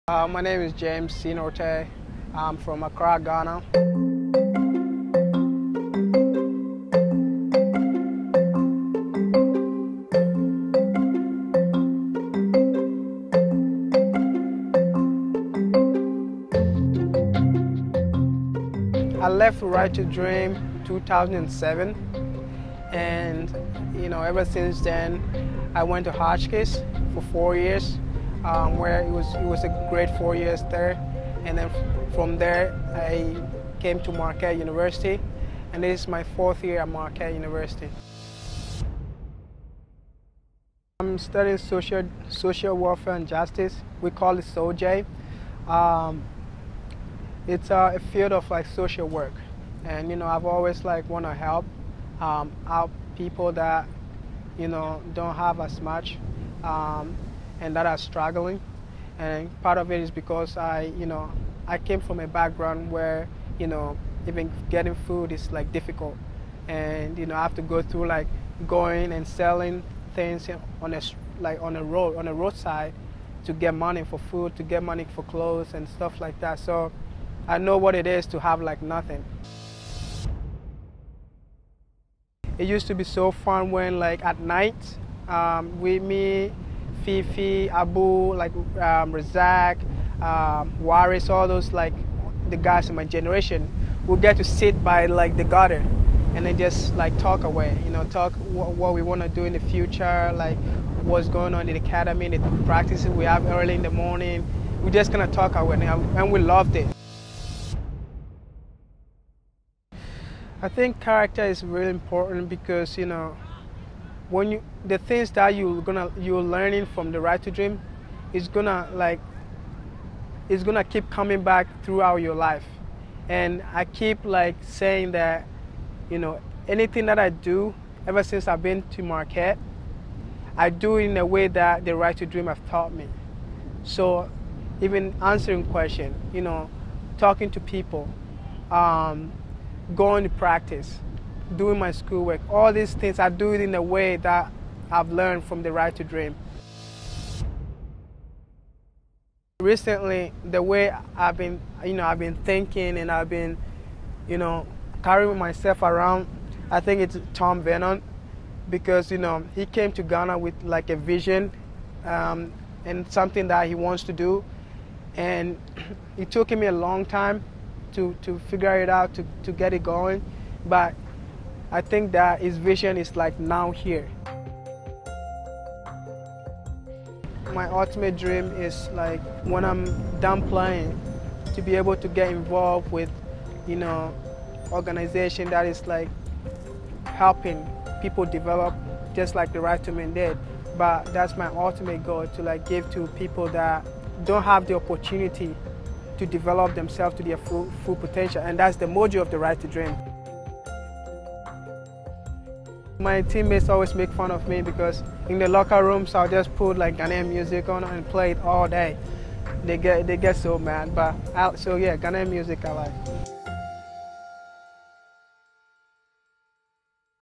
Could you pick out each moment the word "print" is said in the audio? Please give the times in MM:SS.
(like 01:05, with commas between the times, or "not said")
not said.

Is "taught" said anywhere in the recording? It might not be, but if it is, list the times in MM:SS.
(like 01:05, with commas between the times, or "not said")
02:12.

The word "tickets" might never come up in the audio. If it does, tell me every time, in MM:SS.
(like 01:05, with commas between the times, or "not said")
not said.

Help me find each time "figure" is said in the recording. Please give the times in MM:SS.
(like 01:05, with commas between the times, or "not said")
02:48.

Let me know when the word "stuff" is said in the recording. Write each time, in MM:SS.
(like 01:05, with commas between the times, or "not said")
01:15.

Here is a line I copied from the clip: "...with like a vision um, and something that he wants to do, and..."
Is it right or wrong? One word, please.
right.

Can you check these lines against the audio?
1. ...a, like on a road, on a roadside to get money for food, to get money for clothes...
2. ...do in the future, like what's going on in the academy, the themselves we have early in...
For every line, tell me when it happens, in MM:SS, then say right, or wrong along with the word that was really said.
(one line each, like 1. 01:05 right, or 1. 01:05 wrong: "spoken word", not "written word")
1. 01:10 right
2. 01:39 wrong: "practices", not "themselves".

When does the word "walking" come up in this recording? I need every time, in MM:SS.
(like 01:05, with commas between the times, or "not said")
not said.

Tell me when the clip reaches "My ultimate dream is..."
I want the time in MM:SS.
02:57.